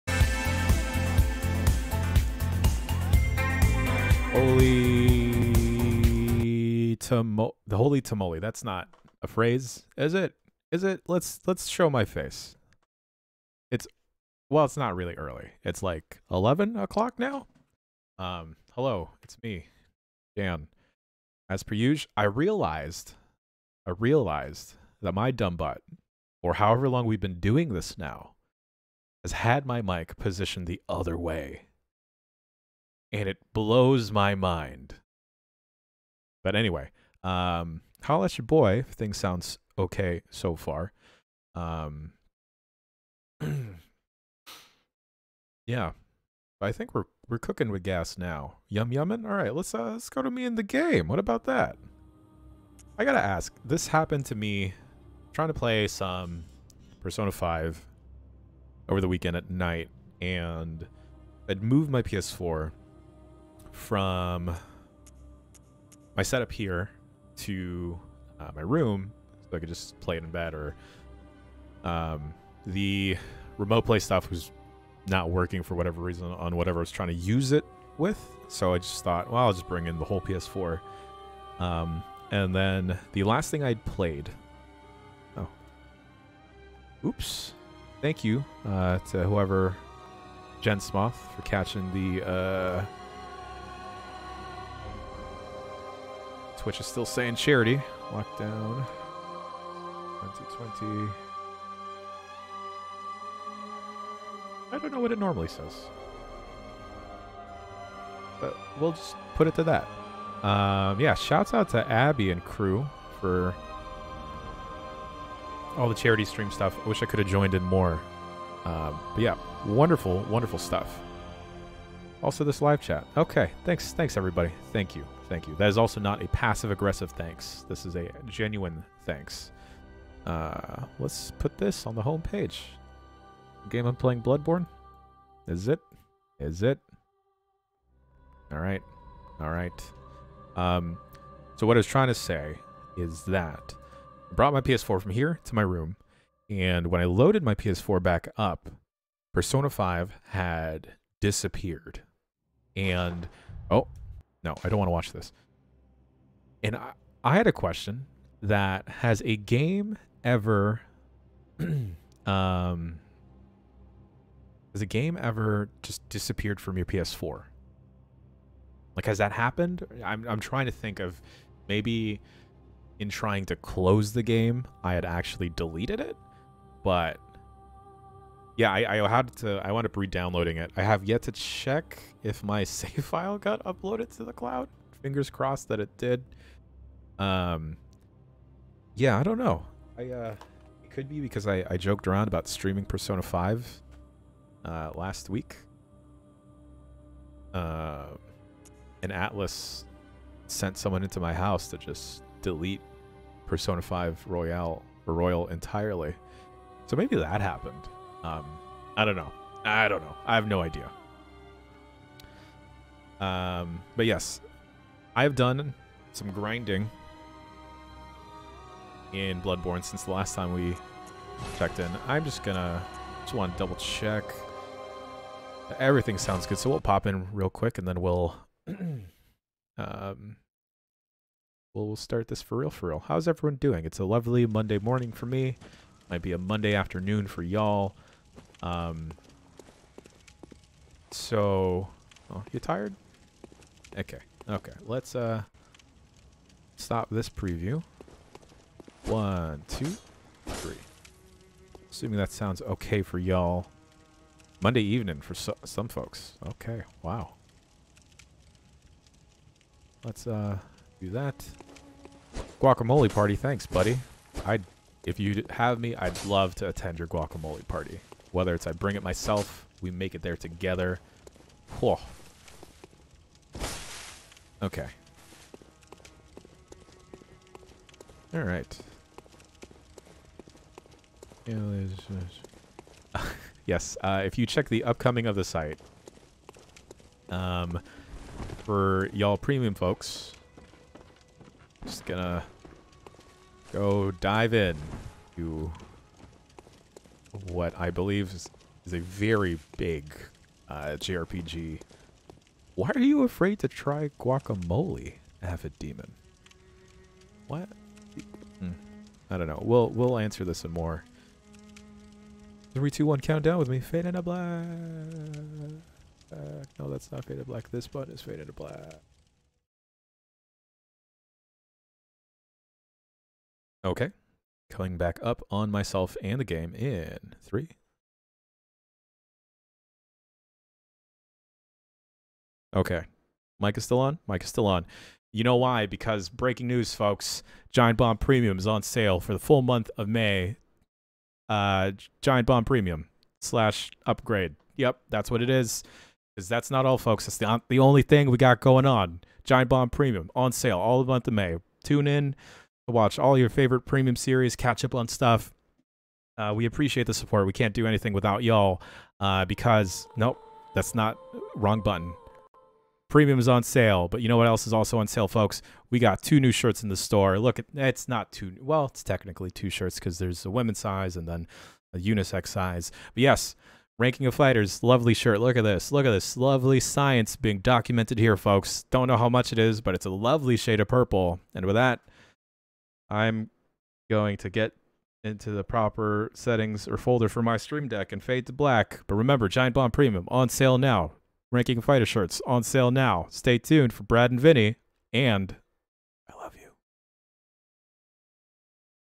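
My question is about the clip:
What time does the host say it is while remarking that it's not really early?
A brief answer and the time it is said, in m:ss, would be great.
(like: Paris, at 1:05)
11 o'clock, at 0:16.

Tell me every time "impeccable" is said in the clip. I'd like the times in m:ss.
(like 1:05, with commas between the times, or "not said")
not said.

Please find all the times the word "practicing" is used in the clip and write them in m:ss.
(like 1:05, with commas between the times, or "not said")
not said.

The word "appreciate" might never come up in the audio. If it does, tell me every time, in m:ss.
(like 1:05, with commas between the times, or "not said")
5:56.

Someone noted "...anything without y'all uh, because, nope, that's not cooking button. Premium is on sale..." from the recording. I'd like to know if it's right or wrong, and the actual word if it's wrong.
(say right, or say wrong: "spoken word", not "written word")
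wrong: "wrong", not "cooking".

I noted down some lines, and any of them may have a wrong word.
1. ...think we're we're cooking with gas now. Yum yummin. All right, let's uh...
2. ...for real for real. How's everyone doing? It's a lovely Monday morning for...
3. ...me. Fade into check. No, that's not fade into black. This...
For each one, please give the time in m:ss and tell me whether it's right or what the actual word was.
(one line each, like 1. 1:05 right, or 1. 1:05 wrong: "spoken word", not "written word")
1. 0:46 right
2. 3:52 right
3. 5:13 wrong: "black", not "check".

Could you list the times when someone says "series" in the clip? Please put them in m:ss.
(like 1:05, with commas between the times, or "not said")
5:54.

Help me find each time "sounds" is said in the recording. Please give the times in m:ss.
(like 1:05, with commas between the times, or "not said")
0:39, 3:46, 4:12.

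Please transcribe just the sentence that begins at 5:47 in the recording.
That's the, the only thing we got going on.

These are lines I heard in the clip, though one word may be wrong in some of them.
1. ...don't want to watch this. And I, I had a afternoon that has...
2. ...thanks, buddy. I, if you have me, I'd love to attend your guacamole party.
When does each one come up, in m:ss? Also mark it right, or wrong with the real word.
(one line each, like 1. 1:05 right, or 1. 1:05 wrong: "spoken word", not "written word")
1. 2:34 wrong: "question", not "afternoon"
2. 4:23 right.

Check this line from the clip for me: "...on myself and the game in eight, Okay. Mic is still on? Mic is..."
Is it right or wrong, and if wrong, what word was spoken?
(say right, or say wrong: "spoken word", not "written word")
wrong: "three", not "eight".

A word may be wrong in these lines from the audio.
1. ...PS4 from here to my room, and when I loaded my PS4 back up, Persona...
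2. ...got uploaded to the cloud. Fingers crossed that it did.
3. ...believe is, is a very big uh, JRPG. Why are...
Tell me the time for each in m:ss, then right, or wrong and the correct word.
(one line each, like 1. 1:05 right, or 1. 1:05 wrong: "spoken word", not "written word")
1. 2:24 right
2. 3:03 right
3. 4:57 right.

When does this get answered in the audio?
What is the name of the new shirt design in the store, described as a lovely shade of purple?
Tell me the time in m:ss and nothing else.
6:13.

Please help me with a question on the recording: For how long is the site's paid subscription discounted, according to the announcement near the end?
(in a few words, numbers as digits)
the full month of May.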